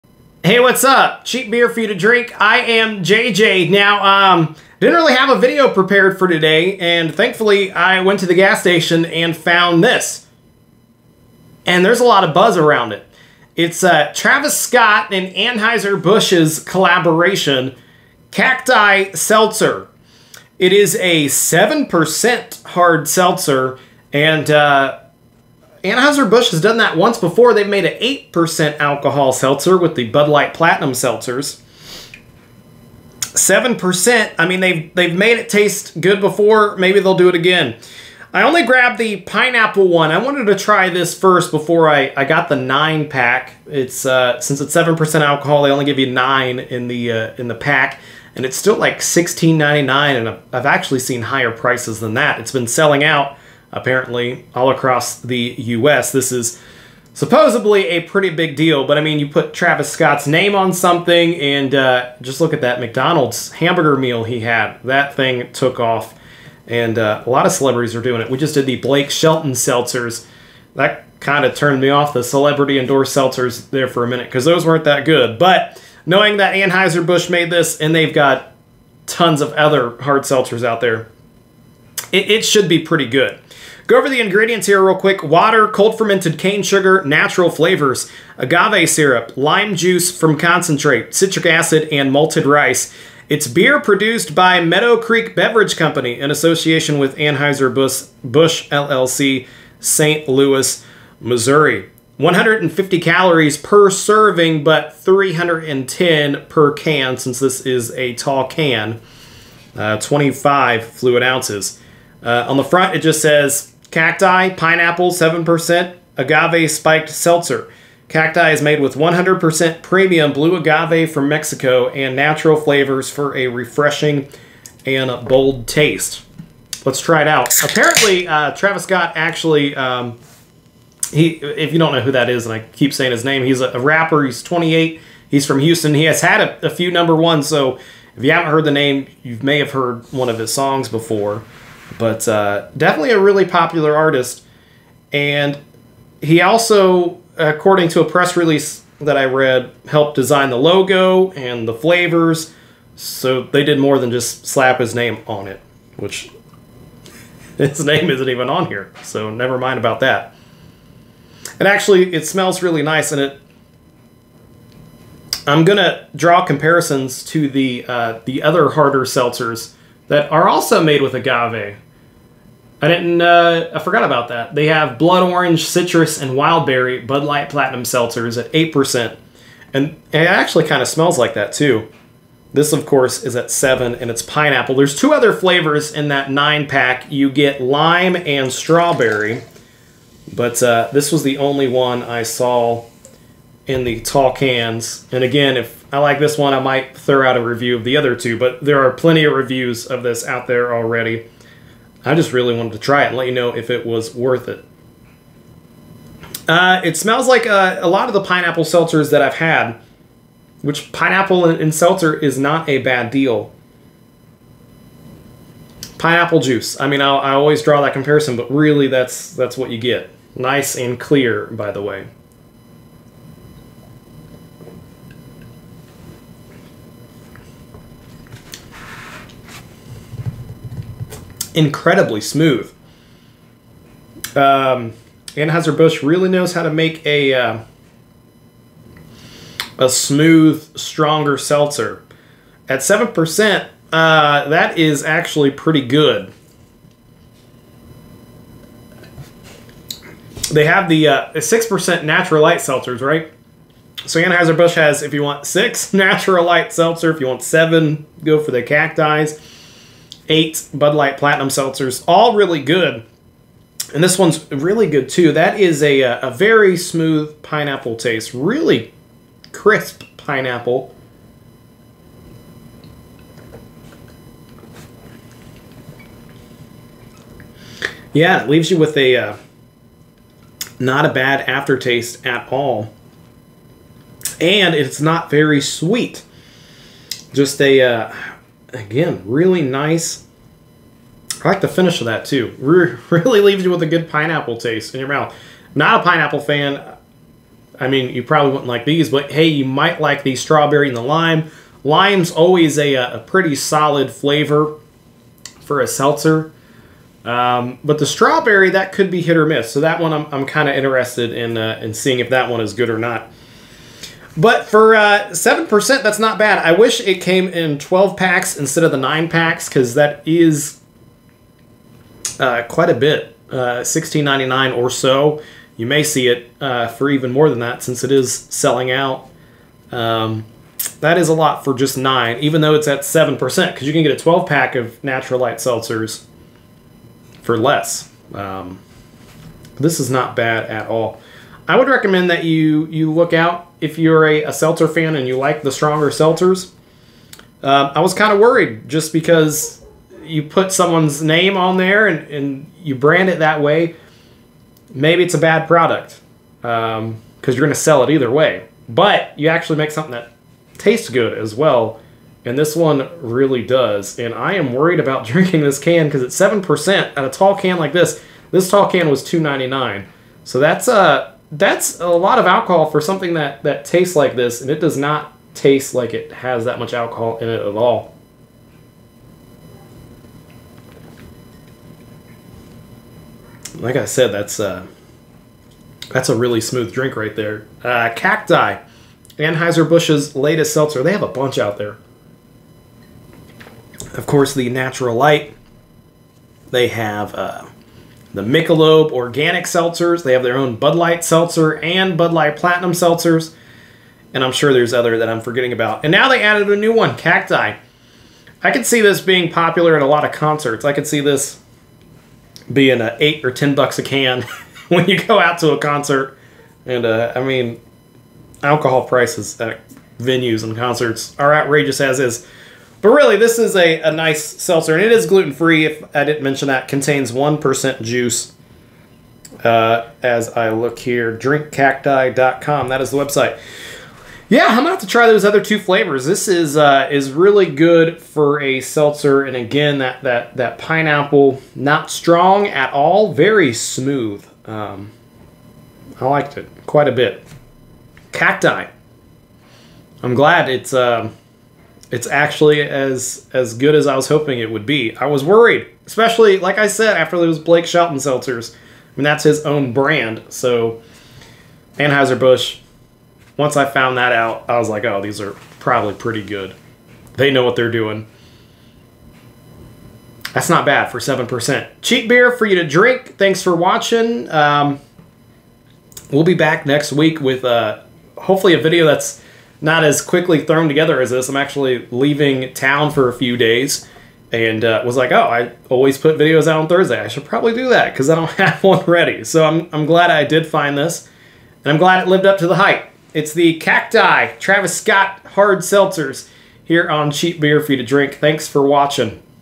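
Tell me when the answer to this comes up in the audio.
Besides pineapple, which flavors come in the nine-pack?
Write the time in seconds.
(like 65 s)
187 s.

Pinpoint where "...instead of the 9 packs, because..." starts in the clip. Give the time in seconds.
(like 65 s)
318 s.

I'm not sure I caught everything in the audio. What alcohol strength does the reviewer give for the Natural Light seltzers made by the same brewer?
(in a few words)
6%.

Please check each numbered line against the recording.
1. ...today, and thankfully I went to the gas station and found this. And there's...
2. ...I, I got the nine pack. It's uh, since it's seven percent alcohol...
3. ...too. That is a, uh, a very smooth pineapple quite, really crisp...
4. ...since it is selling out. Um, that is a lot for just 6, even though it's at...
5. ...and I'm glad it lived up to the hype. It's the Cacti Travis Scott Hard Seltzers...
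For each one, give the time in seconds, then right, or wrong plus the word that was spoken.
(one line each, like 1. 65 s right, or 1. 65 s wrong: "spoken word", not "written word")
1. 6 s right
2. 41 s right
3. 265 s wrong: "taste", not "quite"
4. 327 s wrong: "9", not "6"
5. 491 s right.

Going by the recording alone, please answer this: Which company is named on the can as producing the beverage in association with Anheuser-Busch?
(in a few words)
Meadow Creek Beverage Company.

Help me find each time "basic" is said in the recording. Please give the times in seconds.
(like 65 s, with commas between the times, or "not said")
not said.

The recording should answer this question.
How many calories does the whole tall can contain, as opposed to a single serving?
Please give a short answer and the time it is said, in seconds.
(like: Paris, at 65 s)
310, at 104 s.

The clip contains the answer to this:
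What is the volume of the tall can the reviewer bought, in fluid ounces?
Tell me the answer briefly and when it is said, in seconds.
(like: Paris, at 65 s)
25, at 109 s.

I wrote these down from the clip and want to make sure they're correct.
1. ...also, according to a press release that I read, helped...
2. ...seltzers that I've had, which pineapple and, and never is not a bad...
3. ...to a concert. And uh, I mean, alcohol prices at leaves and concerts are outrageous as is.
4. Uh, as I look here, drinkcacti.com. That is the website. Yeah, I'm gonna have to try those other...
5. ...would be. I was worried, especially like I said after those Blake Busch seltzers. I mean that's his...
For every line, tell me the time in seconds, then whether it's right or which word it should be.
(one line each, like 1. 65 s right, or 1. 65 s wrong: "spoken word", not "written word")
1. 146 s right
2. 208 s wrong: "seltzer", not "never"
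3. 415 s wrong: "venues", not "leaves"
4. 429 s right
5. 454 s wrong: "Shelton", not "Busch".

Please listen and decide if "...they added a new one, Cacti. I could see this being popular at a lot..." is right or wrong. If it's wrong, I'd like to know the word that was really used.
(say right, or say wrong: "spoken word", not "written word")
right.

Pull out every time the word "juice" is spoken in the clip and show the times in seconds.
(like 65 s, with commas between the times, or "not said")
89 s, 216 s, 428 s.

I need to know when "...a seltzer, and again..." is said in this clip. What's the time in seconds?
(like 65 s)
438 s.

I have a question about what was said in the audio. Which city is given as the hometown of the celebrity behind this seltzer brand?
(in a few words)
Houston.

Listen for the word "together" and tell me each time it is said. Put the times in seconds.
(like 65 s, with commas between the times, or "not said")
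480 s.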